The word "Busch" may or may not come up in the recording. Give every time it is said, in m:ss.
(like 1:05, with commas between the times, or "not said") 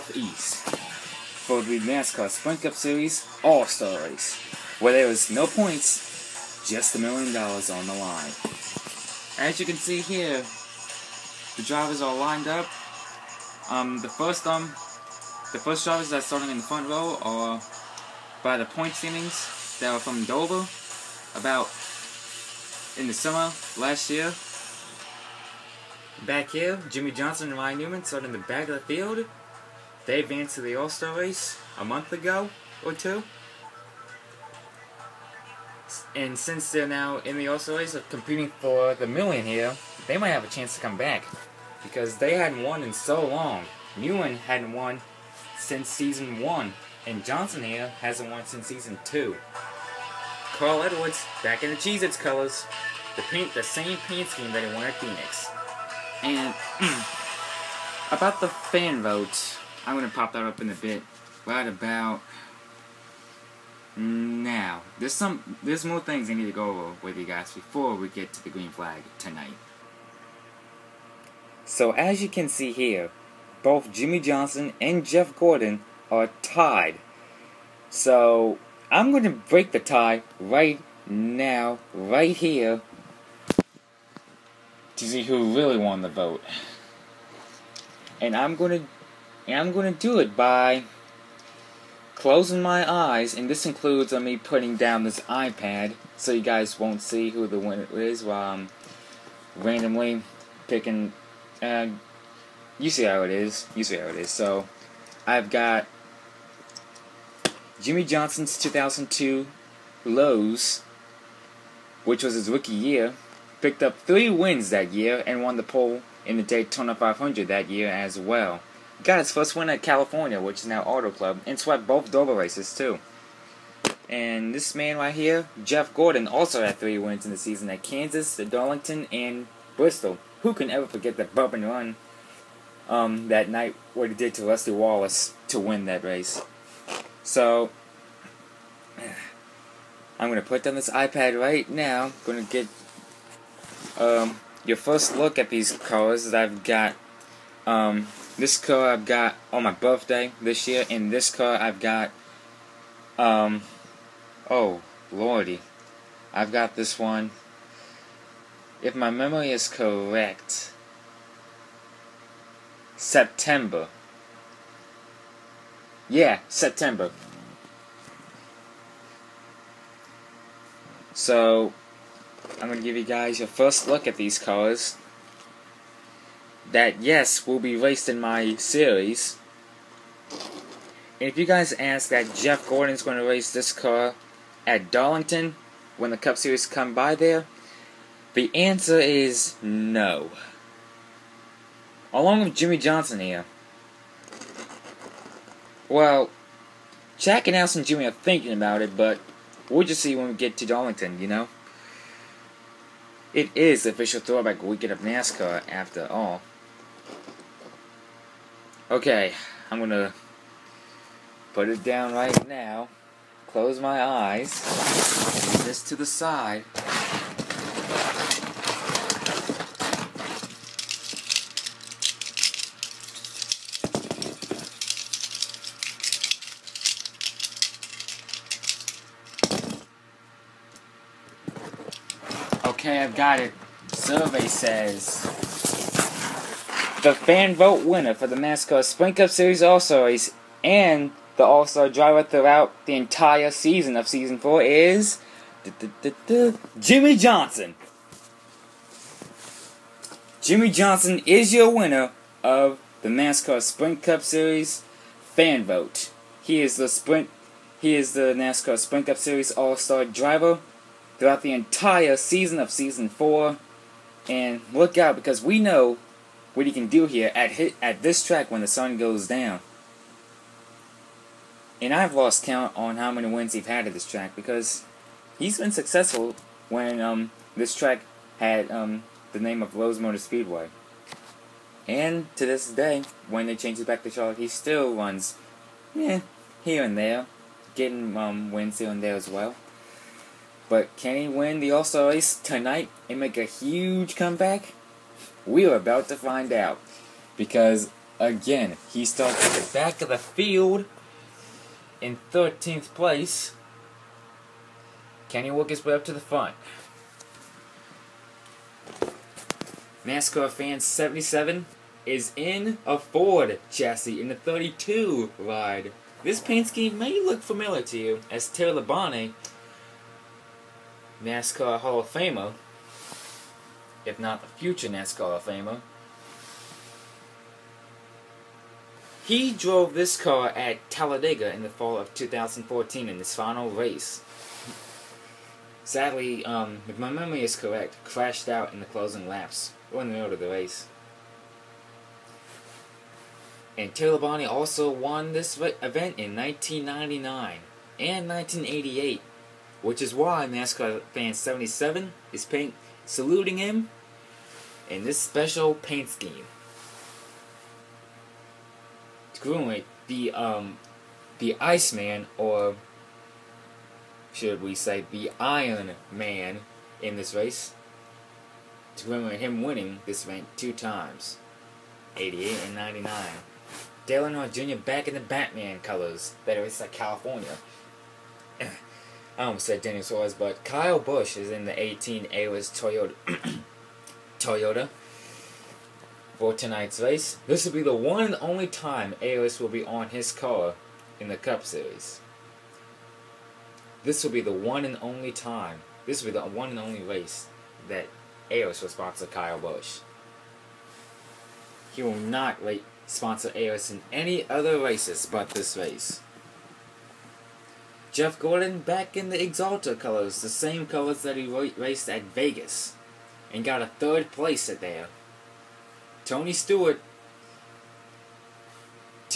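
6:20, 6:39.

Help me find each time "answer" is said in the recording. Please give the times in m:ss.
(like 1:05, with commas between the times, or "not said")
3:08.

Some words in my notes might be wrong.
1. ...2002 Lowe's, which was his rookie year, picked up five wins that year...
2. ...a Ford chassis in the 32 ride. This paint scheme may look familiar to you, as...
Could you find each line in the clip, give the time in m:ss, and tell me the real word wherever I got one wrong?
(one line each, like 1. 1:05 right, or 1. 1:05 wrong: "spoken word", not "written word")
1. 1:48 wrong: "three", not "five"
2. 5:12 right.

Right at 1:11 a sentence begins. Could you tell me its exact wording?
So as you can see here, both Jimmy Johnson and Jeff Gordon are tied.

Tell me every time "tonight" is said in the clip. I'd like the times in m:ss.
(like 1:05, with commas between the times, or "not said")
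1:09, 4:52, 6:26.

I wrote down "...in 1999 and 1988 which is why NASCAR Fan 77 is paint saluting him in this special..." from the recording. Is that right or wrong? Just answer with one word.
right.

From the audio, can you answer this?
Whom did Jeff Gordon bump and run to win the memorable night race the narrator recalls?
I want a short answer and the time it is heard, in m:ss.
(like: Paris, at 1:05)
Lester Wallace, at 2:14.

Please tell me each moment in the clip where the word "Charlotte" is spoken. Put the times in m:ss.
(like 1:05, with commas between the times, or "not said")
4:44.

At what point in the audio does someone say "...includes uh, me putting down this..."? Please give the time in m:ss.
1:33.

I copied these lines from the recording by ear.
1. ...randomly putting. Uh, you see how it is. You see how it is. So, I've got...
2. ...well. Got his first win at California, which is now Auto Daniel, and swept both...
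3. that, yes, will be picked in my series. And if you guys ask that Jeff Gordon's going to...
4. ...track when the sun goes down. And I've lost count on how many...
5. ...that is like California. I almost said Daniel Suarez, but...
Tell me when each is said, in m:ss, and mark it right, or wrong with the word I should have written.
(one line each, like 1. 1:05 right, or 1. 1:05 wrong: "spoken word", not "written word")
1. 1:39 wrong: "picking", not "putting"
2. 1:58 wrong: "Club", not "Daniel"
3. 2:56 wrong: "raced", not "picked"
4. 4:28 right
5. 6:16 right.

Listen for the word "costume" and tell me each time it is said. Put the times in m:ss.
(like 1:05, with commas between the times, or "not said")
not said.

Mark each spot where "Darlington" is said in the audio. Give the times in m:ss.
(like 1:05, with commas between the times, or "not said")
2:08, 3:04, 3:20.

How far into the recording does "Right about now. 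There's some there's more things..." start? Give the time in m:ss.
1:01.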